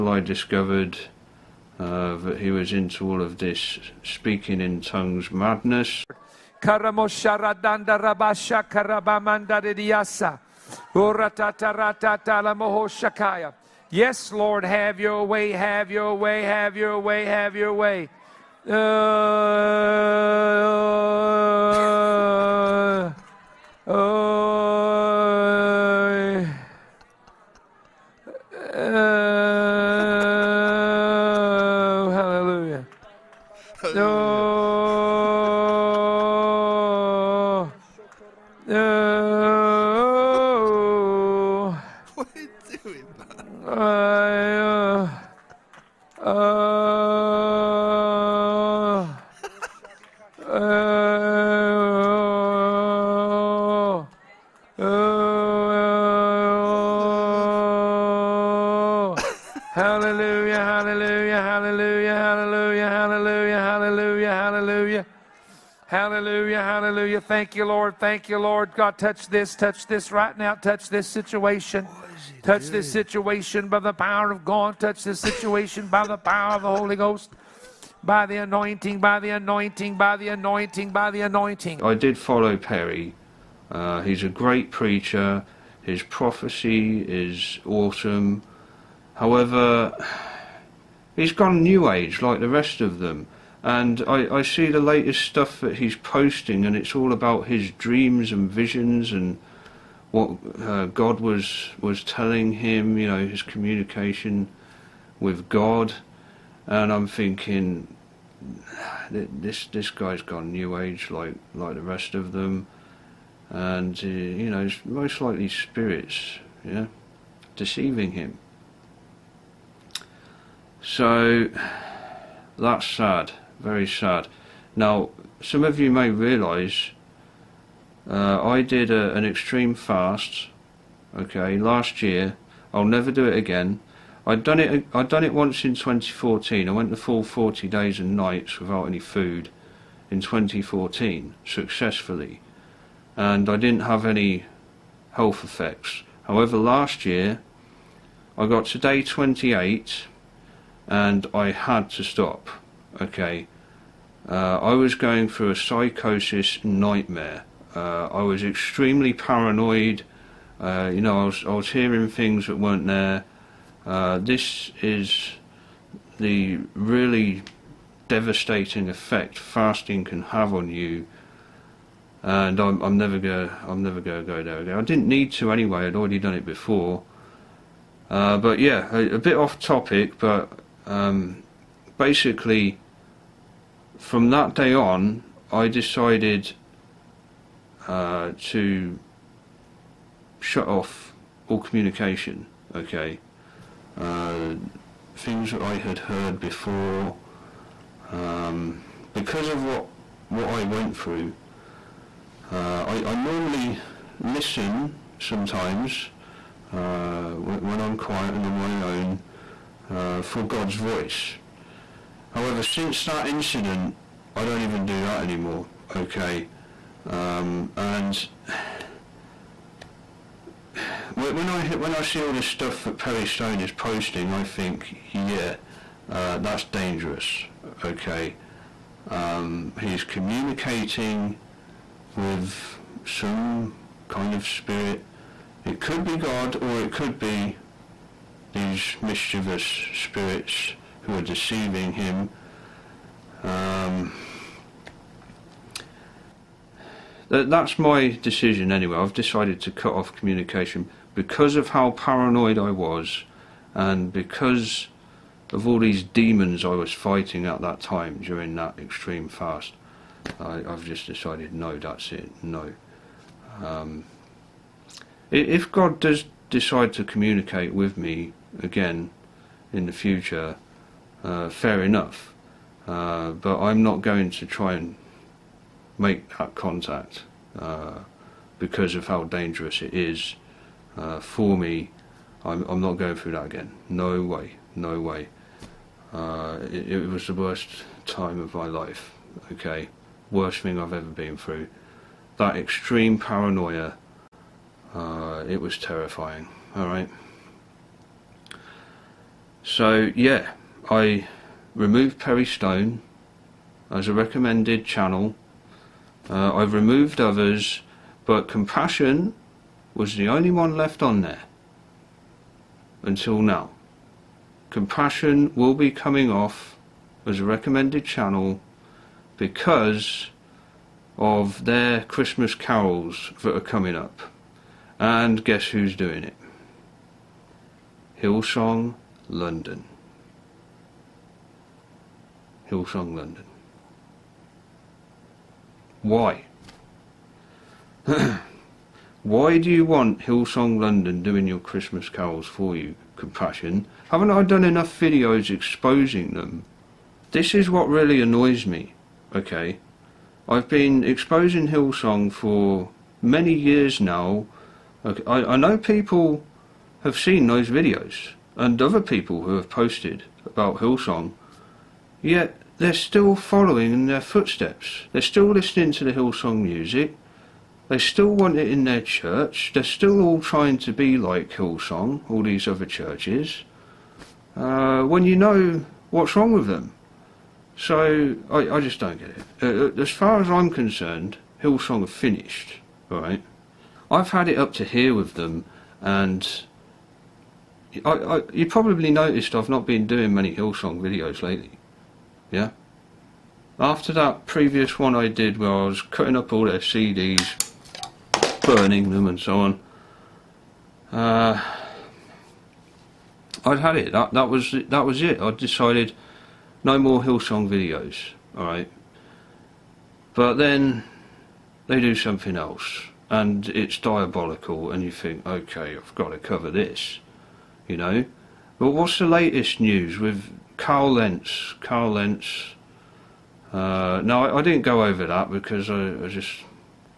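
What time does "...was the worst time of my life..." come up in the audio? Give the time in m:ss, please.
4:47.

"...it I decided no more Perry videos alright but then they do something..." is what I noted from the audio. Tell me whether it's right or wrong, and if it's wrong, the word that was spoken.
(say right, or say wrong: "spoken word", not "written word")
wrong: "Hillsong", not "Perry".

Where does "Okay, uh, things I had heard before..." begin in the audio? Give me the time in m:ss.
3:12.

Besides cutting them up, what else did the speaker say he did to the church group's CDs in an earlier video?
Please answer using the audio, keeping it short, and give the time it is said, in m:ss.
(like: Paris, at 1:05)
burning them, at 6:38.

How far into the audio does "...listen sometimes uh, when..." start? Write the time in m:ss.
3:24.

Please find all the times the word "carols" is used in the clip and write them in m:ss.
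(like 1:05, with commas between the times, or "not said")
5:22, 5:42.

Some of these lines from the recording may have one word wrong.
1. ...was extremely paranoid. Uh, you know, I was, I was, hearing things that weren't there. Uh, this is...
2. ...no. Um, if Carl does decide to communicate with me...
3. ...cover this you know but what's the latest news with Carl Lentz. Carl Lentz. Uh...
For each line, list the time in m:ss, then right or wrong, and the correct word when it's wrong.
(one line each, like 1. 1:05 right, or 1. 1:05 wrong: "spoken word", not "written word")
1. 2:38 right
2. 4:22 wrong: "God", not "Carl"
3. 6:56 right.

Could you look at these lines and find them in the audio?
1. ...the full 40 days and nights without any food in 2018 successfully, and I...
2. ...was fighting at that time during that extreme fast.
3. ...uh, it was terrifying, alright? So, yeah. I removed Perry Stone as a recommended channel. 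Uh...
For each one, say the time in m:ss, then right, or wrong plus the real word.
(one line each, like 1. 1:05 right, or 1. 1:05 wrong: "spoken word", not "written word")
1. 2:16 wrong: "2014", not "2018"
2. 4:16 right
3. 4:54 right.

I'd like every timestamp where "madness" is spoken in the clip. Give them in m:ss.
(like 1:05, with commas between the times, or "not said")
0:05.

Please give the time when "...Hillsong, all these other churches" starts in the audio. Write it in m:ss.
6:11.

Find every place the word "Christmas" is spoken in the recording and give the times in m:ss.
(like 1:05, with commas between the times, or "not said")
5:22, 5:41.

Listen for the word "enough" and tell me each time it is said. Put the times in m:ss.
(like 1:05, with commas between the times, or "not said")
4:31, 5:44.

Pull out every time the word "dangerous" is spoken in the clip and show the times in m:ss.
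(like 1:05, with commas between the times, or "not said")
3:46, 4:39.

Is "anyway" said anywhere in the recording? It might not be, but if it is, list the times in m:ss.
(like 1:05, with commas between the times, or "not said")
2:55, 4:08.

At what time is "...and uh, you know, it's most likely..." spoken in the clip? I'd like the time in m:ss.
1:53.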